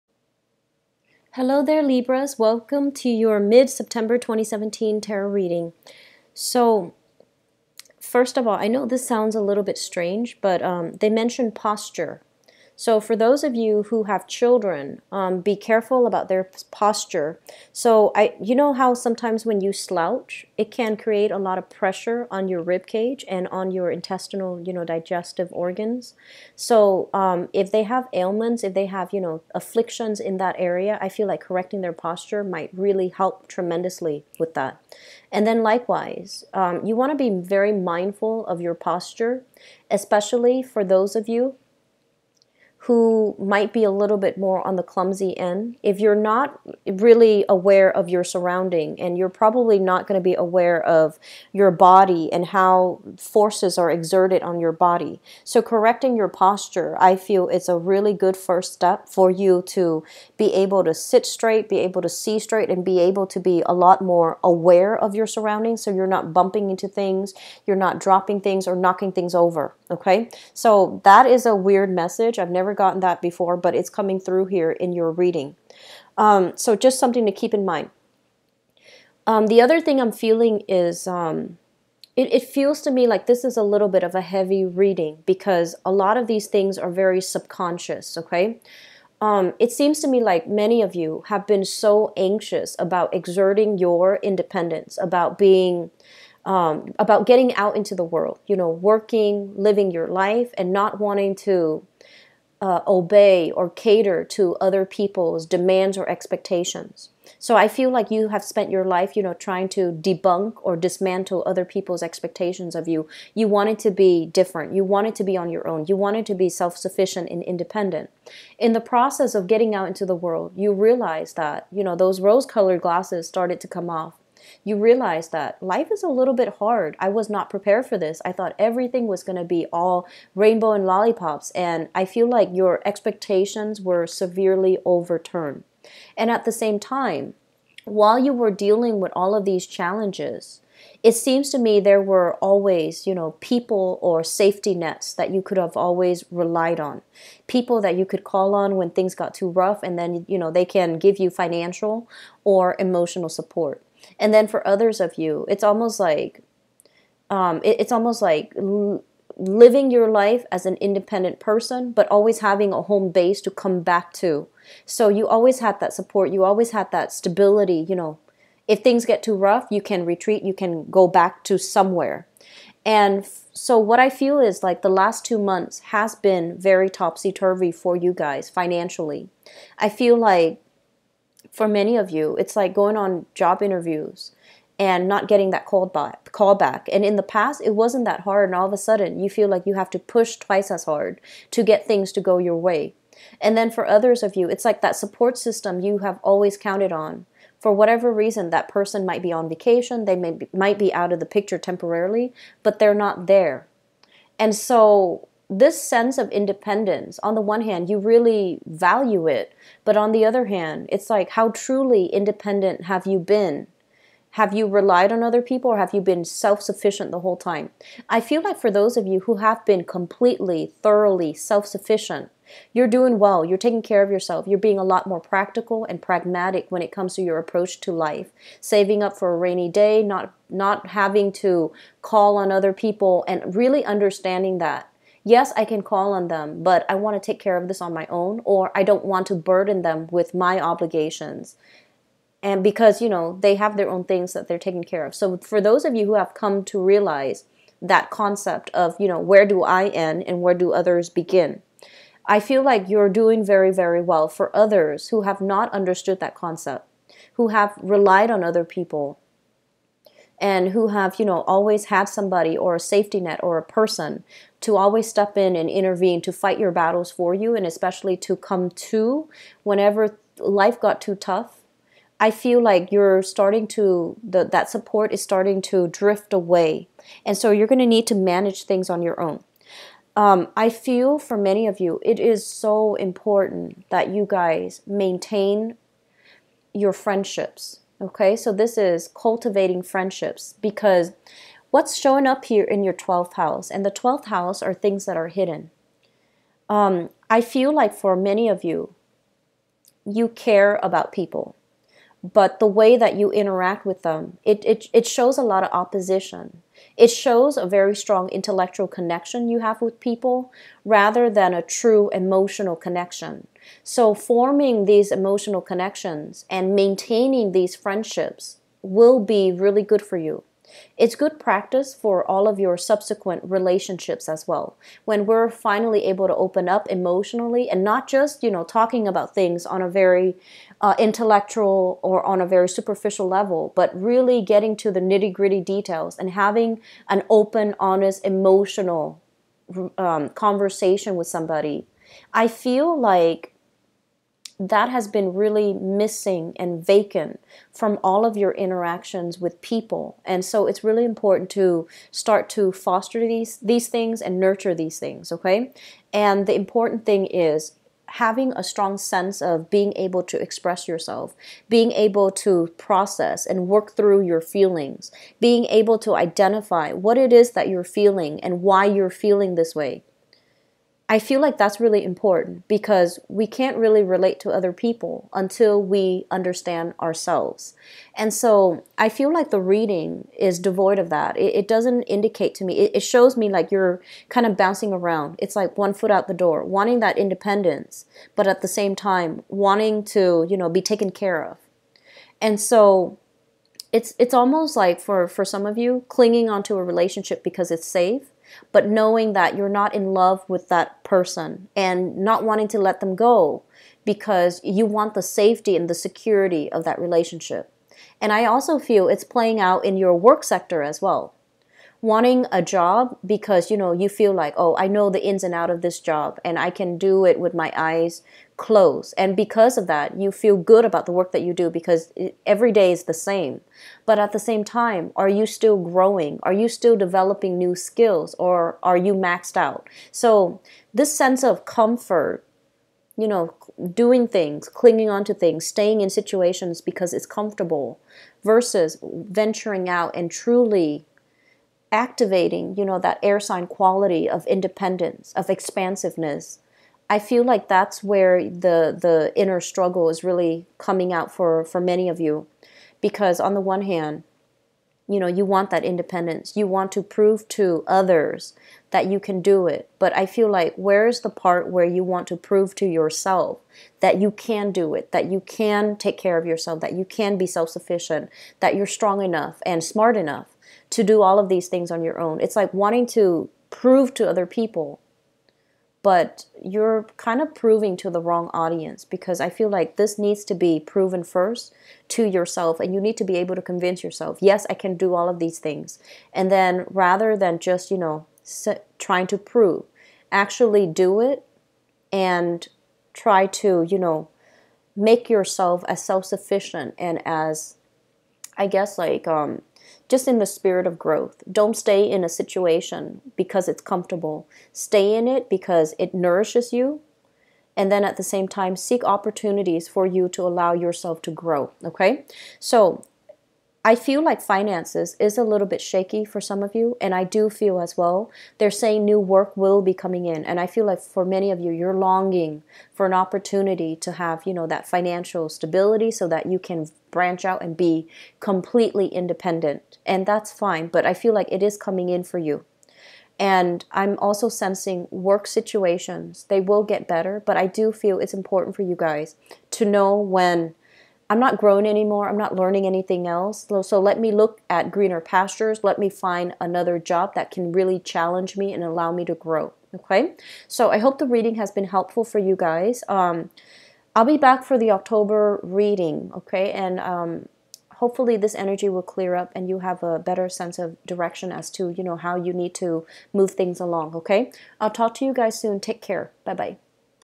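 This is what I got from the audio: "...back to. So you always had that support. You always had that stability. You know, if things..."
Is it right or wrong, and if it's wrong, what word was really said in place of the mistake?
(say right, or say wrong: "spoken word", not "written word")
right.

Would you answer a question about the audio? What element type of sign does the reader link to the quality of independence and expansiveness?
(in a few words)
air sign.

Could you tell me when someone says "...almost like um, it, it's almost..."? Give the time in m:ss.
2:35.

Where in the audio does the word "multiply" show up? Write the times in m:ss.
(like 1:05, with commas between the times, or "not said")
not said.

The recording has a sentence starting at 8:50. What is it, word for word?
And that's fine, but I feel like it is coming in for you.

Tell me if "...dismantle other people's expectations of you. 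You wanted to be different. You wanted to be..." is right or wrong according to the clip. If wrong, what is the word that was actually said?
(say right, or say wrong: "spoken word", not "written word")
right.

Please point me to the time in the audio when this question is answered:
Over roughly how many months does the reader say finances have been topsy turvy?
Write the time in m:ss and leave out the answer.
2:55.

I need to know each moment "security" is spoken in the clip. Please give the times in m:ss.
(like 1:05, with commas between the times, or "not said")
6:45.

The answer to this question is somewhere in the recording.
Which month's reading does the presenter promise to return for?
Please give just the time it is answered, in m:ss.
9:14.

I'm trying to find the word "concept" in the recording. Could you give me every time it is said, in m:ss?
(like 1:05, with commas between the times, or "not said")
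4:08, 4:16.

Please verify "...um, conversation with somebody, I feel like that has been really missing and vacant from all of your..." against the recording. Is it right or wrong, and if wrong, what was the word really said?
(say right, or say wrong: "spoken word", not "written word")
right.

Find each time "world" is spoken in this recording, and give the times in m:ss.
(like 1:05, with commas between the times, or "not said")
1:38, 2:00.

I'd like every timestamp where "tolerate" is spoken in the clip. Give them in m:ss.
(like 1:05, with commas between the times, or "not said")
not said.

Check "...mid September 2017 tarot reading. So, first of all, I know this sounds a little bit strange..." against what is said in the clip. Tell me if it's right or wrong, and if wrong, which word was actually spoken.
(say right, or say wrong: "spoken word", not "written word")
right.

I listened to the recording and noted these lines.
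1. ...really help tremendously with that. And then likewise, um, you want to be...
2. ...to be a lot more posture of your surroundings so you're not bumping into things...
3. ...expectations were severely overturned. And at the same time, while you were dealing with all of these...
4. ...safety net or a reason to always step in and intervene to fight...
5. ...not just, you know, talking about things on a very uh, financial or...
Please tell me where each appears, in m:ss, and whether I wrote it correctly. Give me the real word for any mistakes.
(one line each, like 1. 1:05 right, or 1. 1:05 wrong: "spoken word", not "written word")
1. 0:32 right
2. 1:03 wrong: "aware", not "posture"
3. 2:12 right
4. 4:22 wrong: "person", not "reason"
5. 5:27 wrong: "intellectual", not "financial".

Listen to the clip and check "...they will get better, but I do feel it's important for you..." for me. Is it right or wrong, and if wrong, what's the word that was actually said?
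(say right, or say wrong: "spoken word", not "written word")
right.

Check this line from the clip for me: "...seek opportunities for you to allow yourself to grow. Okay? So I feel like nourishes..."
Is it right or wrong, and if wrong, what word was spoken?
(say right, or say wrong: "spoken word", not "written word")
wrong: "finances", not "nourishes".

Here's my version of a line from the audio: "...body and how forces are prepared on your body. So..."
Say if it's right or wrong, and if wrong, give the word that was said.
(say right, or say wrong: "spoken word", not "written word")
wrong: "exerted", not "prepared".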